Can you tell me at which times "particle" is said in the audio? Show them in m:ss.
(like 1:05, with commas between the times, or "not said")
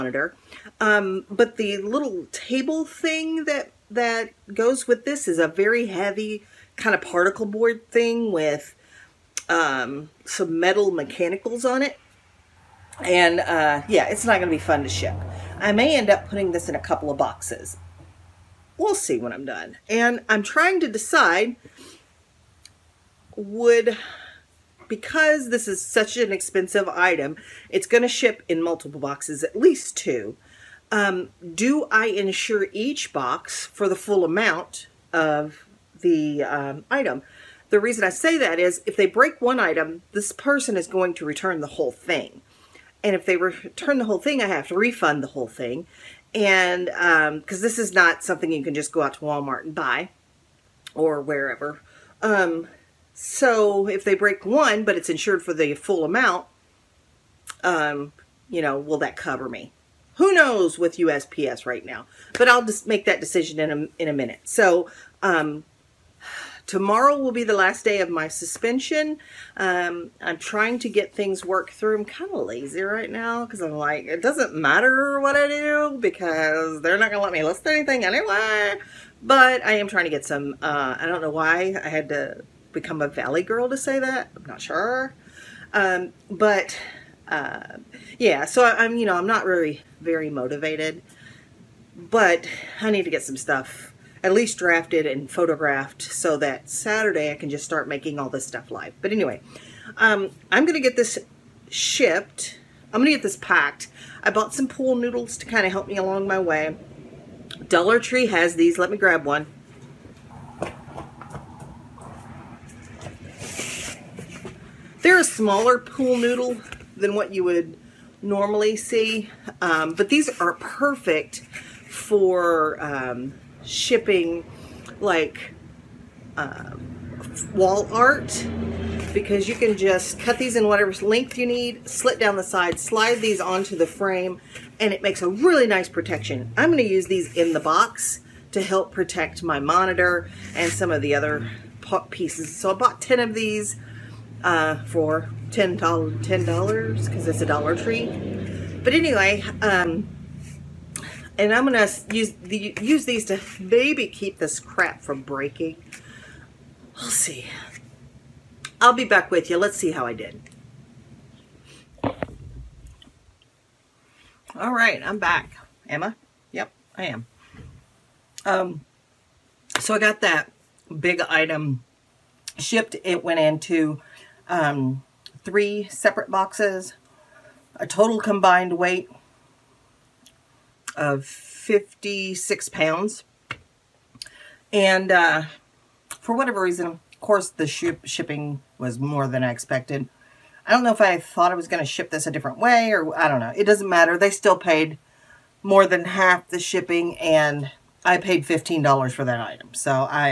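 0:07.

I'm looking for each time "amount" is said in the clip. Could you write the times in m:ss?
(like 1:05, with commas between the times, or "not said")
0:34, 0:56.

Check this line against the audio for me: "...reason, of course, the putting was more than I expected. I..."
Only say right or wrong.
wrong.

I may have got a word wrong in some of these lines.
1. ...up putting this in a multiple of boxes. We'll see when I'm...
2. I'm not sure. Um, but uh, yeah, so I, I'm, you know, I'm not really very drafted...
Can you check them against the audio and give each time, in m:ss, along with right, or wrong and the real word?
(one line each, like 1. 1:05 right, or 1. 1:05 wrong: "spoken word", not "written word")
1. 0:16 wrong: "couple", not "multiple"
2. 1:24 wrong: "motivated", not "drafted".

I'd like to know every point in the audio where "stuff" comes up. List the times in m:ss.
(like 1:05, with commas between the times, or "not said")
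1:33, 1:38.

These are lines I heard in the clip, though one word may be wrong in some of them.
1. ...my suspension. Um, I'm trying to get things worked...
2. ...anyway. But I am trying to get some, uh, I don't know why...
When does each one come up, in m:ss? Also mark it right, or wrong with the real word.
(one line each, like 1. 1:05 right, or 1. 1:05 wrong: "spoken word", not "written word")
1. 1:08 right
2. 1:18 right.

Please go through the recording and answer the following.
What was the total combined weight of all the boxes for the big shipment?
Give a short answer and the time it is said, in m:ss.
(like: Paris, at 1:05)
56 pounds, at 3:01.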